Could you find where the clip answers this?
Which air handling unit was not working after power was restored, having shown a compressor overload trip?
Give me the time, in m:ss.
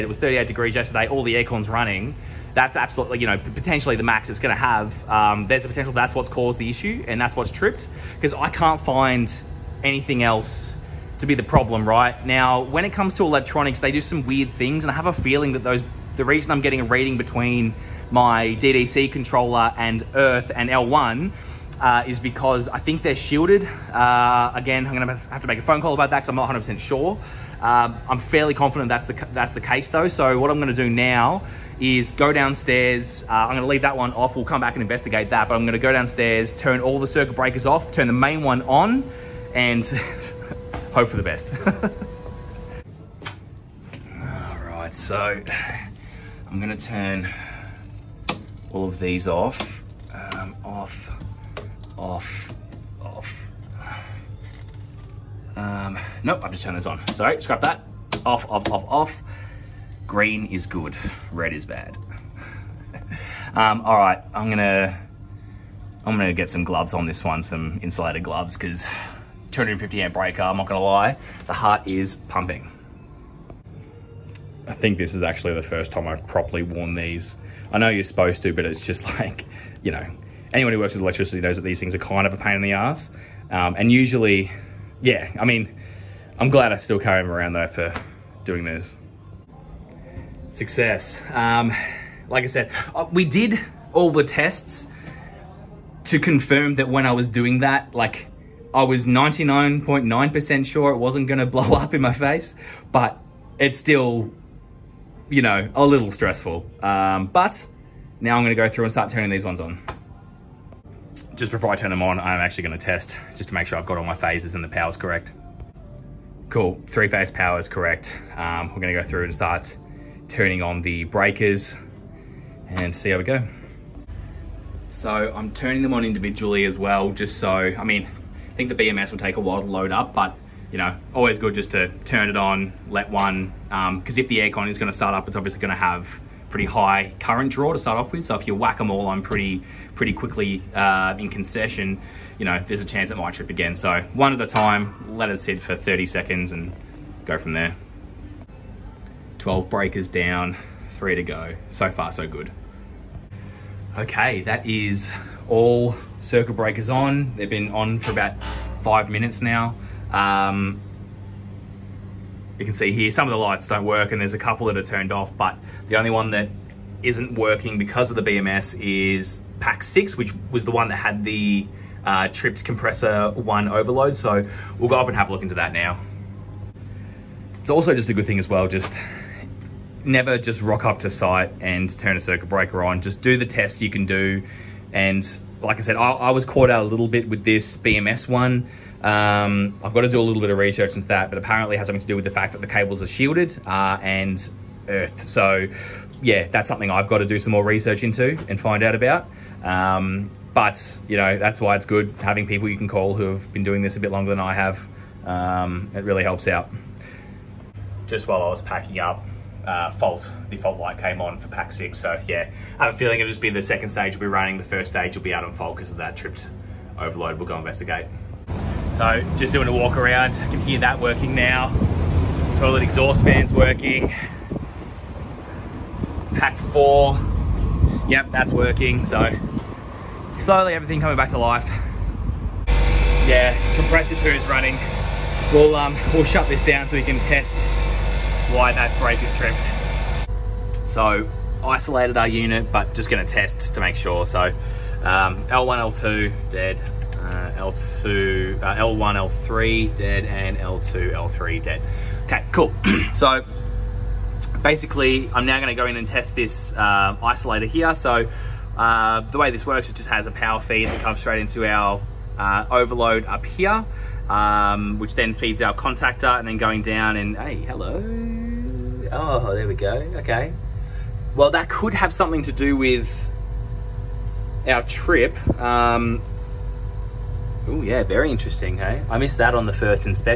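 2:49.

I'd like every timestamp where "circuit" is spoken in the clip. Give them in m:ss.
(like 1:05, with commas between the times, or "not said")
0:37, 2:36, 3:02.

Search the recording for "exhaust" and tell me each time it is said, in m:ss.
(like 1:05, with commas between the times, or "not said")
3:42.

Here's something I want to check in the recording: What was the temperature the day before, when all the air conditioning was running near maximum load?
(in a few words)
38 degrees.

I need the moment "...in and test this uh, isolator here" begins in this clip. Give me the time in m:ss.
4:15.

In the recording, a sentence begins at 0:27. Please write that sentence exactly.
Um, I'm fairly confident that's the, that's the case though.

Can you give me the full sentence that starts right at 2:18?
So if you whack them all on pretty pretty quickly uh, in concession, you know, there's a chance it might trip again.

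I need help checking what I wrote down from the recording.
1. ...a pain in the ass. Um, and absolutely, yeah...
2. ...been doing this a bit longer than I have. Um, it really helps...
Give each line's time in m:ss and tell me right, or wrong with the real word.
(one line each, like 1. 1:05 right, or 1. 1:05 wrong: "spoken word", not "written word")
1. 1:22 wrong: "usually", not "absolutely"
2. 3:23 right.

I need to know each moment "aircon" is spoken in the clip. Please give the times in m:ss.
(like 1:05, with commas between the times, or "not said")
0:01, 2:14.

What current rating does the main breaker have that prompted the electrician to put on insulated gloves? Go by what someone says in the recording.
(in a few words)
250 amp.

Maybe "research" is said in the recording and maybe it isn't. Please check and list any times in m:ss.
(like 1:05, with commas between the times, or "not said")
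3:10, 3:17.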